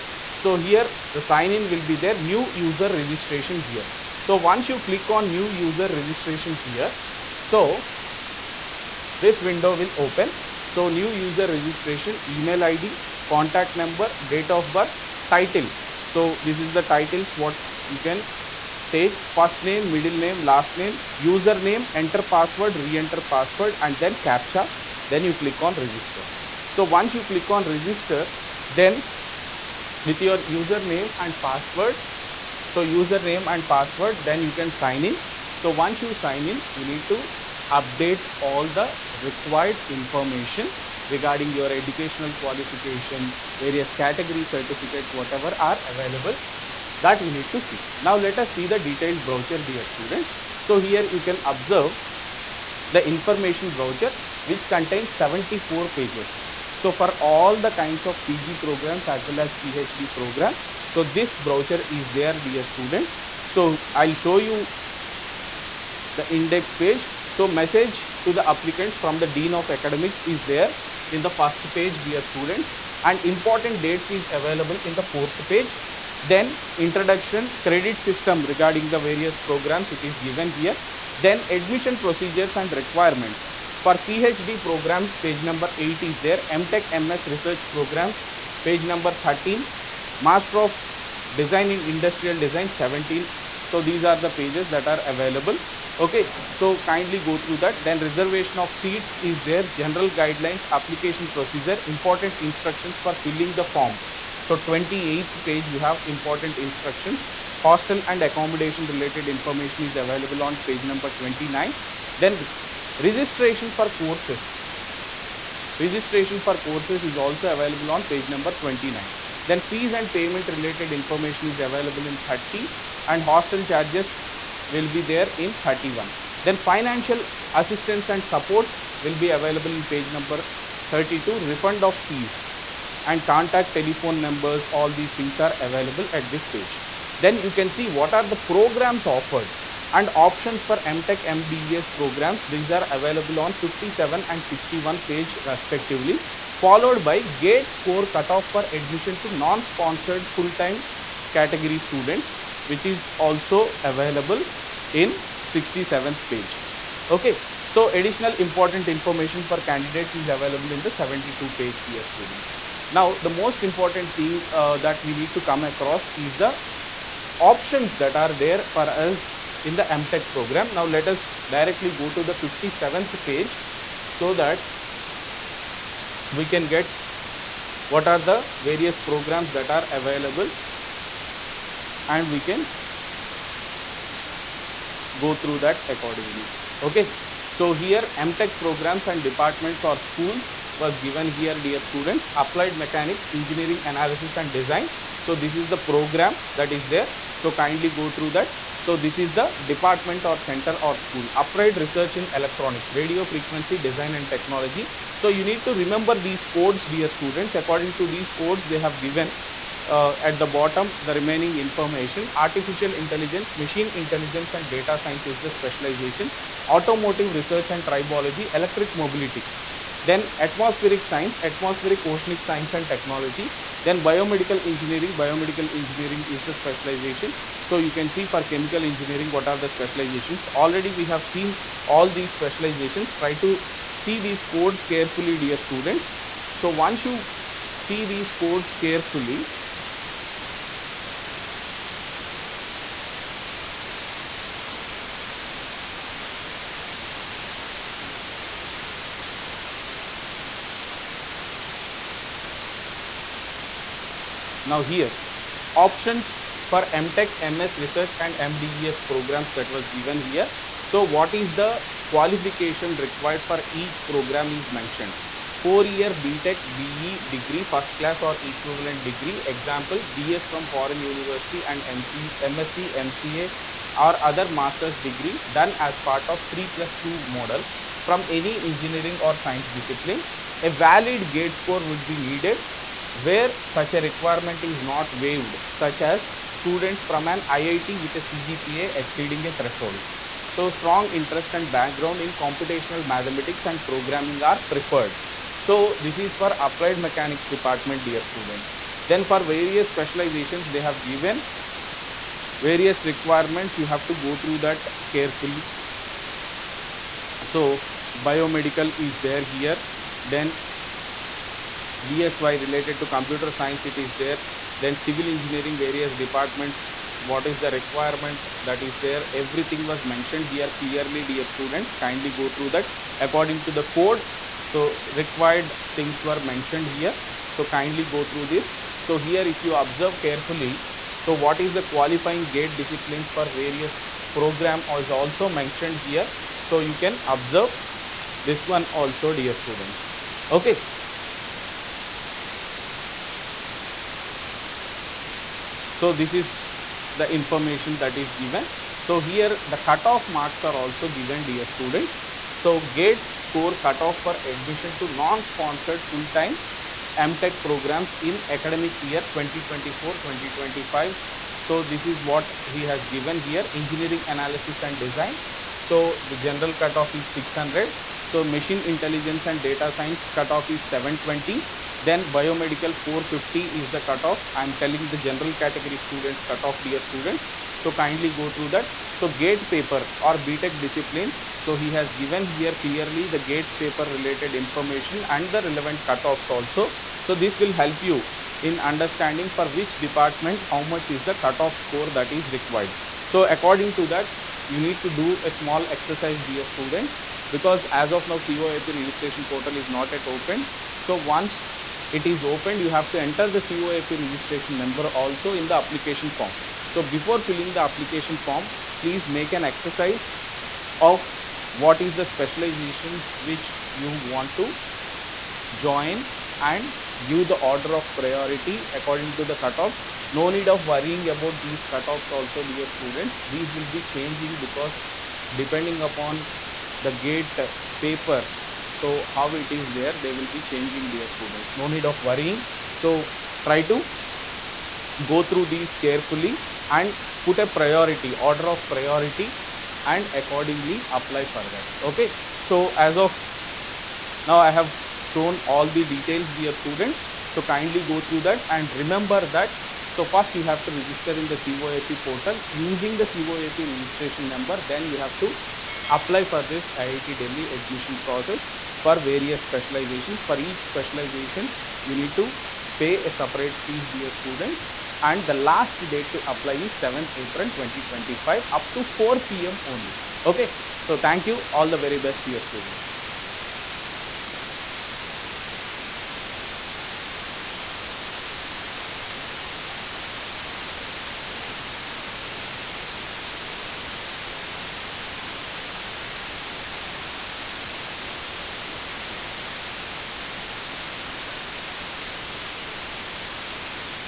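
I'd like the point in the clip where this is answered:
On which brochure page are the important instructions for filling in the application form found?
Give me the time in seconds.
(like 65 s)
104 s.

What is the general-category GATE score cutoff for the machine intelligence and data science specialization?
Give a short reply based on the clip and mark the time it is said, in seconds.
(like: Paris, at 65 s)
720, at 370 s.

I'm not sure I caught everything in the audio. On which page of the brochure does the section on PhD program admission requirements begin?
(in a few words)
8.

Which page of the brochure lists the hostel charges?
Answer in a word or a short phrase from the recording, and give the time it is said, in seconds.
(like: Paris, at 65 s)
31, at 125 s.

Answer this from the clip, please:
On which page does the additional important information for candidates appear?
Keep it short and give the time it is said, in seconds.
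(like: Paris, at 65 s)
72, at 160 s.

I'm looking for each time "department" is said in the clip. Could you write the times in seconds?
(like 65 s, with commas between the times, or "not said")
189 s, 199 s, 297 s, 316 s, 389 s.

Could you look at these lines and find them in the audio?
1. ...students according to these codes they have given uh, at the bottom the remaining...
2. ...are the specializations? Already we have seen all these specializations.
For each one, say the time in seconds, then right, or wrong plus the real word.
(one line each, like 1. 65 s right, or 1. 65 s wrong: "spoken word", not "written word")
1. 207 s right
2. 229 s right.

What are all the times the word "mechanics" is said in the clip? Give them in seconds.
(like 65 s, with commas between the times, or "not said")
192 s, 296 s.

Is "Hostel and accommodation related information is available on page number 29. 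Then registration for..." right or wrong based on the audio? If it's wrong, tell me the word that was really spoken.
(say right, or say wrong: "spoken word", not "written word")
right.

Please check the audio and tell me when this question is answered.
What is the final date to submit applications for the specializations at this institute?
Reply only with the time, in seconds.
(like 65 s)
466 s.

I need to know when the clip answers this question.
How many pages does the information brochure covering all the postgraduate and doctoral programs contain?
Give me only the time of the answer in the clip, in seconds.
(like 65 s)
55 s.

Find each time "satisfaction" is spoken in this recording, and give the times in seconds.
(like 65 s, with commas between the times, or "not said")
not said.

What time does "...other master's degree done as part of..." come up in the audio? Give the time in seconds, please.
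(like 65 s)
274 s.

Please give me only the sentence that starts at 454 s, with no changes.
Then you have to apply for this IIT Delhi admission process for various specializations.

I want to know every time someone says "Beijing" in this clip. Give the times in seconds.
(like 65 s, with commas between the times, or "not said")
not said.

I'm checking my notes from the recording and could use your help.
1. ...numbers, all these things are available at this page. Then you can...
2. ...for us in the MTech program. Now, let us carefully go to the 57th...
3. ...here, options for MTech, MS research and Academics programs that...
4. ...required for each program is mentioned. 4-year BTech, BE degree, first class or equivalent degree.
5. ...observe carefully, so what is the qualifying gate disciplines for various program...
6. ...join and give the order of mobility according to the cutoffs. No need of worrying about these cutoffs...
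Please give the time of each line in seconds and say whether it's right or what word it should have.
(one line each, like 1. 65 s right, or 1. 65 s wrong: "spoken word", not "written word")
1. 134 s right
2. 168 s wrong: "directly", not "carefully"
3. 254 s wrong: "MDES", not "Academics"
4. 262 s right
5. 329 s right
6. 415 s wrong: "priority", not "mobility".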